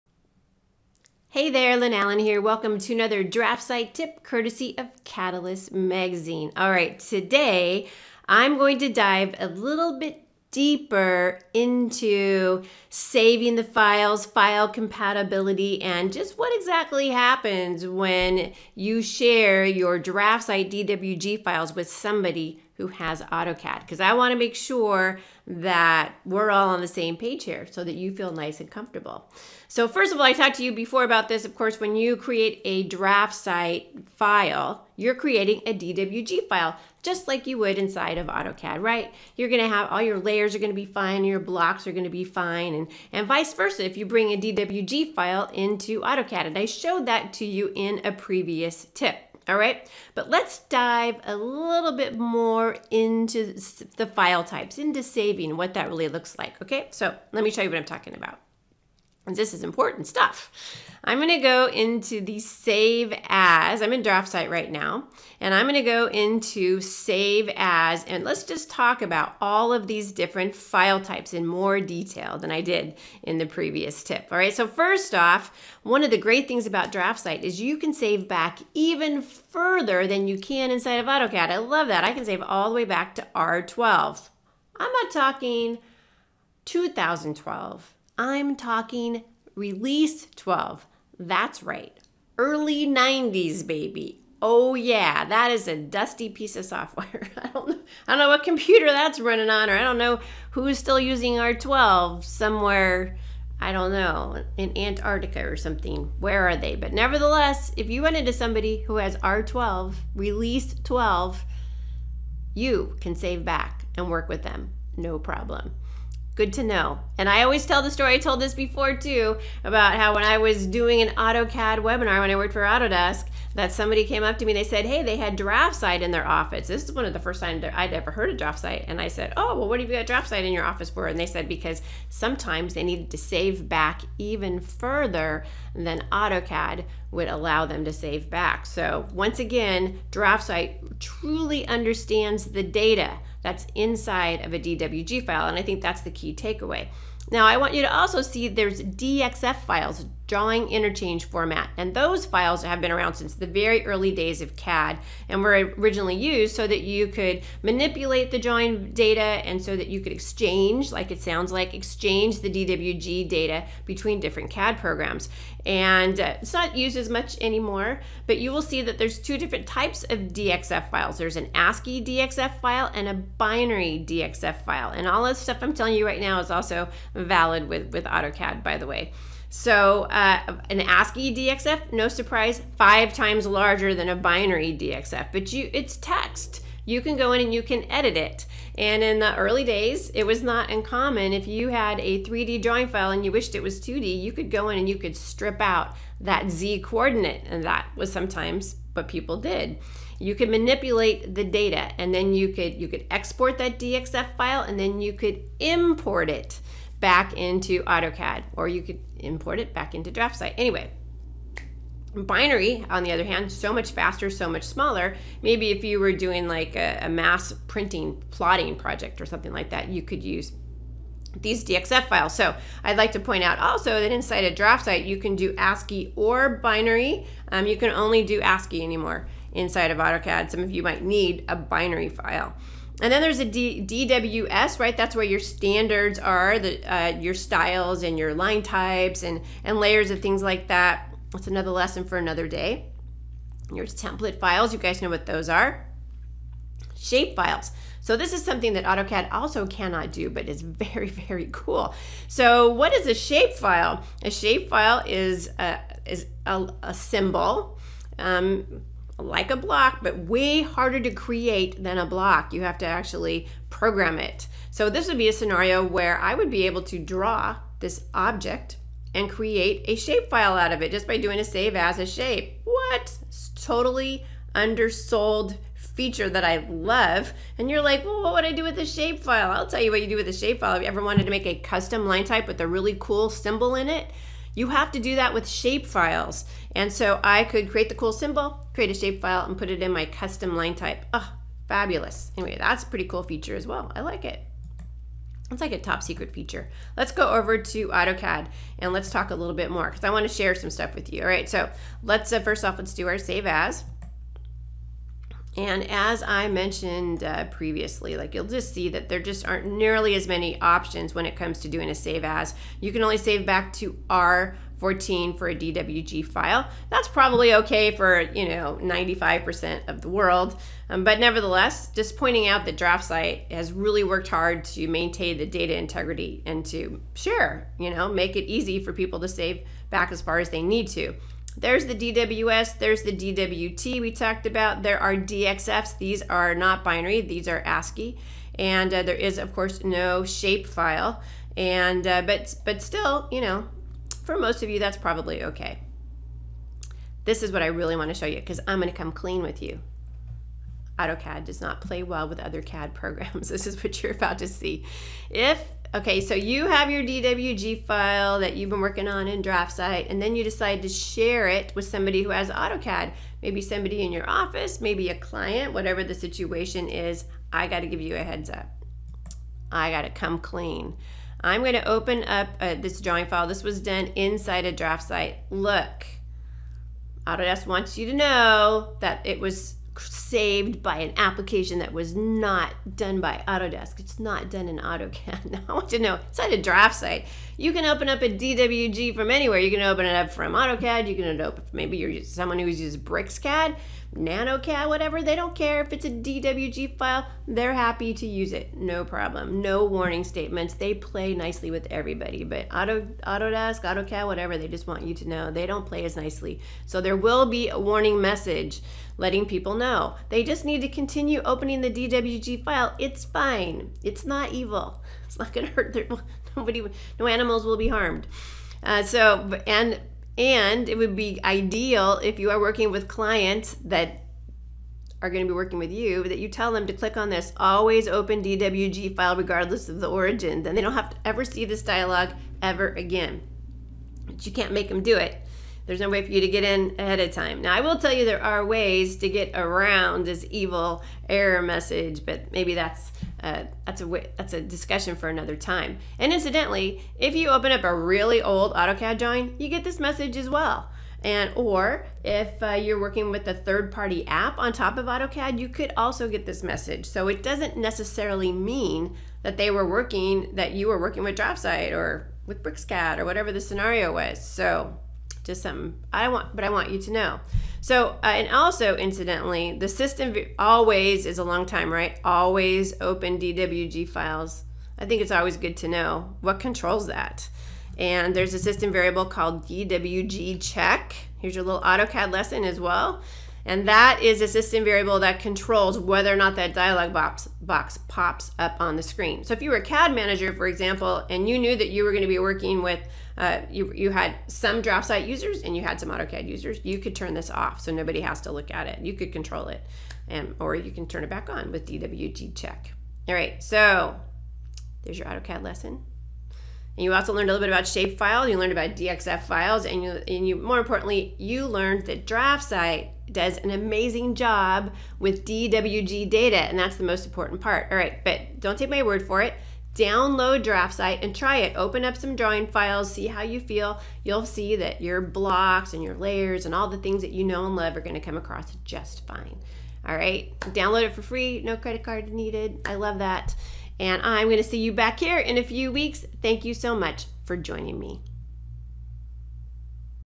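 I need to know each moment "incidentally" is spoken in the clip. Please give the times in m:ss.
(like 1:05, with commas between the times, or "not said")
7:26, 7:48.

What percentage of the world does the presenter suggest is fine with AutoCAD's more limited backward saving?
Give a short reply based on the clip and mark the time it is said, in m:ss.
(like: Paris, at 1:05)
95%, at 5:18.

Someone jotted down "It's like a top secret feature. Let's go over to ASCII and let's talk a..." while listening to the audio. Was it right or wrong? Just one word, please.
wrong.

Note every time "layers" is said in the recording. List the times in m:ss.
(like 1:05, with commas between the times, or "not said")
0:40, 3:59, 8:46.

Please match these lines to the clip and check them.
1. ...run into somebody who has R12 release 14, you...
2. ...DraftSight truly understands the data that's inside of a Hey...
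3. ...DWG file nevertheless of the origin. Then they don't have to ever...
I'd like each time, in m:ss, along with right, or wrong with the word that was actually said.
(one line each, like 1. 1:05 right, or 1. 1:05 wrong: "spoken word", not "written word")
1. 1:48 wrong: "12", not "14"
2. 2:20 wrong: "DWG", not "Hey"
3. 7:08 wrong: "regardless", not "nevertheless".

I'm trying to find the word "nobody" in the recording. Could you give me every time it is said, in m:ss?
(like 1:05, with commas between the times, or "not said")
6:56, 8:17.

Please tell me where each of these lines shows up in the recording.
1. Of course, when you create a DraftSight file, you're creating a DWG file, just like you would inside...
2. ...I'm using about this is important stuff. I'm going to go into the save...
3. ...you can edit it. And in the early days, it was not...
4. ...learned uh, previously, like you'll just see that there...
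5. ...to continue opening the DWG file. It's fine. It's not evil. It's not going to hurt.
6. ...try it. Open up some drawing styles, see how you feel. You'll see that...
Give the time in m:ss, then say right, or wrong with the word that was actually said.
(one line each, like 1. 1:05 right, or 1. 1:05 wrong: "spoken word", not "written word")
1. 0:31 right
2. 0:57 wrong: "talking", not "using"
3. 3:07 right
4. 5:06 wrong: "mentioned", not "learned"
5. 6:50 right
6. 8:41 wrong: "files", not "styles".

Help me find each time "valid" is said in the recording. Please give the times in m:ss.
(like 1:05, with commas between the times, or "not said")
2:57.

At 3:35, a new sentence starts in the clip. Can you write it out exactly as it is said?
Maybe if you were doing like a, a mass printing, plotting project or something like that, you could use these DXF files.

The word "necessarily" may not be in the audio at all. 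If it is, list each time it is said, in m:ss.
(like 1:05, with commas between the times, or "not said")
7:37.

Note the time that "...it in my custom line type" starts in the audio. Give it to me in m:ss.
4:49.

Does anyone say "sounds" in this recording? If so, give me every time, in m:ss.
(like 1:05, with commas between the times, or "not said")
2:41.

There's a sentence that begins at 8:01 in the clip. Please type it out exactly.
Here's your little AutoCAD lesson as well.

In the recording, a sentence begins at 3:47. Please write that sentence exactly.
Um, you can only do ASCII anymore inside of AutoCAD.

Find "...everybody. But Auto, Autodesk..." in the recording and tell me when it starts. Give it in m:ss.
6:41.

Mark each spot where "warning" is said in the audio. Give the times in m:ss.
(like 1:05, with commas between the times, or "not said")
6:39, 6:47.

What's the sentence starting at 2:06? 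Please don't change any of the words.
This is one of the first times I'd ever heard of DraftSight.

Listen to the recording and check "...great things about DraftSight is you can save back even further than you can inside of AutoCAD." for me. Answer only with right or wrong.
right.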